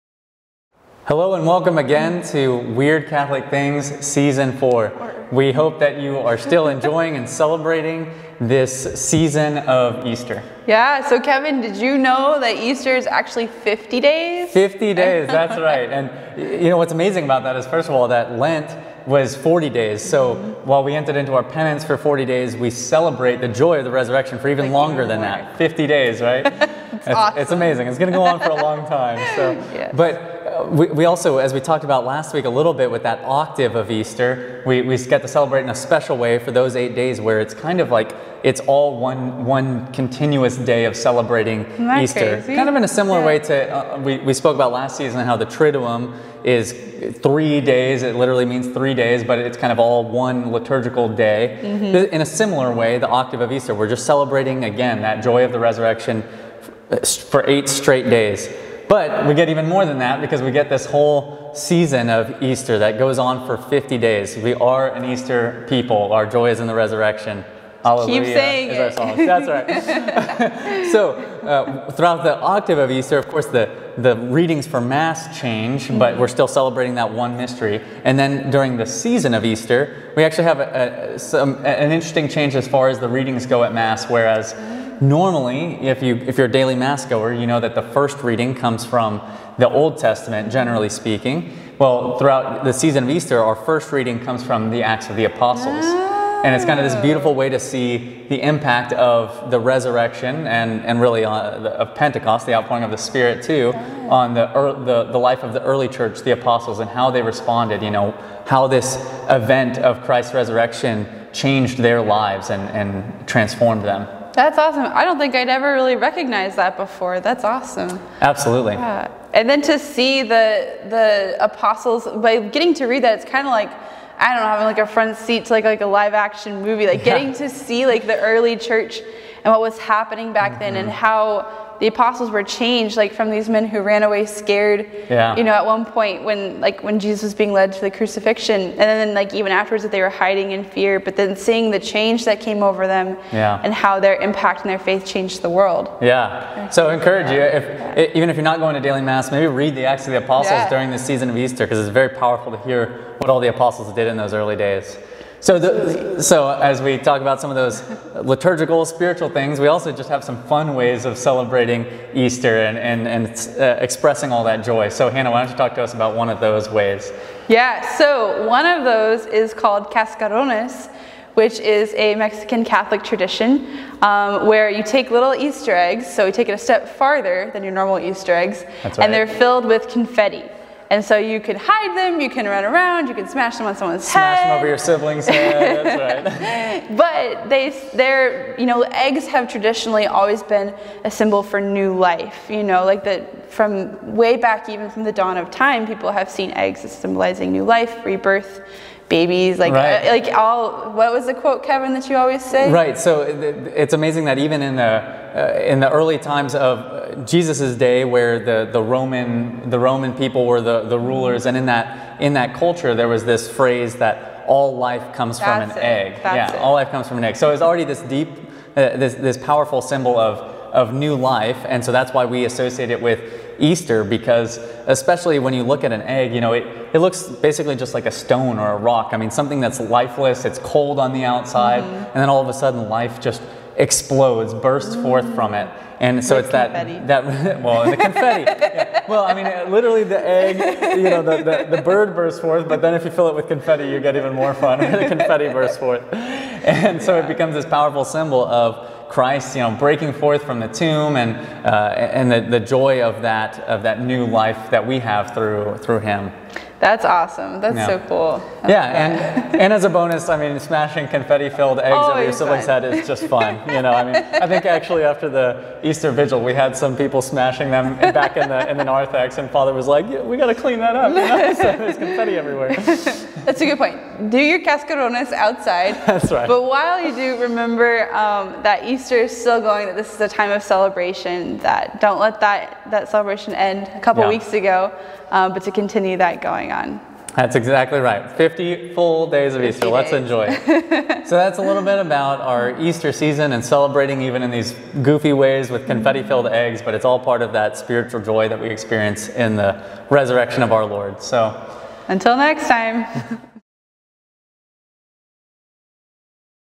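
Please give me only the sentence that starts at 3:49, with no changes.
I mean, something that's lifeless, it's cold on the outside, mm-hmm.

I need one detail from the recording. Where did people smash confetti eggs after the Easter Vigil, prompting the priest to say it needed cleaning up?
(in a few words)
The narthex.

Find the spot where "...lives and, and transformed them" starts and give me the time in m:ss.
1:52.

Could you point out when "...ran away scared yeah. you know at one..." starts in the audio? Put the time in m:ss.
2:13.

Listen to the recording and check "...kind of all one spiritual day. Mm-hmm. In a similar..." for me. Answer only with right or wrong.
wrong.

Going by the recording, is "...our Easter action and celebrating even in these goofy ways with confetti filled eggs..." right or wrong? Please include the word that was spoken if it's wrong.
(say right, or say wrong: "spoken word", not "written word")
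wrong: "season", not "action".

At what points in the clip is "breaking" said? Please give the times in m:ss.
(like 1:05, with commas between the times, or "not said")
4:09.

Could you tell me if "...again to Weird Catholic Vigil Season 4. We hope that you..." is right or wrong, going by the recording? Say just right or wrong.
wrong.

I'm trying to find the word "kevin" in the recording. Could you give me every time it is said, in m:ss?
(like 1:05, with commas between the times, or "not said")
0:11, 3:21.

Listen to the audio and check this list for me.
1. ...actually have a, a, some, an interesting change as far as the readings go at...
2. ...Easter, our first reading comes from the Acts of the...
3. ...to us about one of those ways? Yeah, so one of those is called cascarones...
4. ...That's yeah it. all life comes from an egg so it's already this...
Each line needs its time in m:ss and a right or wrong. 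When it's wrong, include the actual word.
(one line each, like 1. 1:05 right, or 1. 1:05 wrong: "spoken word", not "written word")
1. 1:20 right
2. 1:33 right
3. 2:45 right
4. 3:36 right.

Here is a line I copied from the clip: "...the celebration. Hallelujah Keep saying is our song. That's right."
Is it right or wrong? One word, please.
wrong.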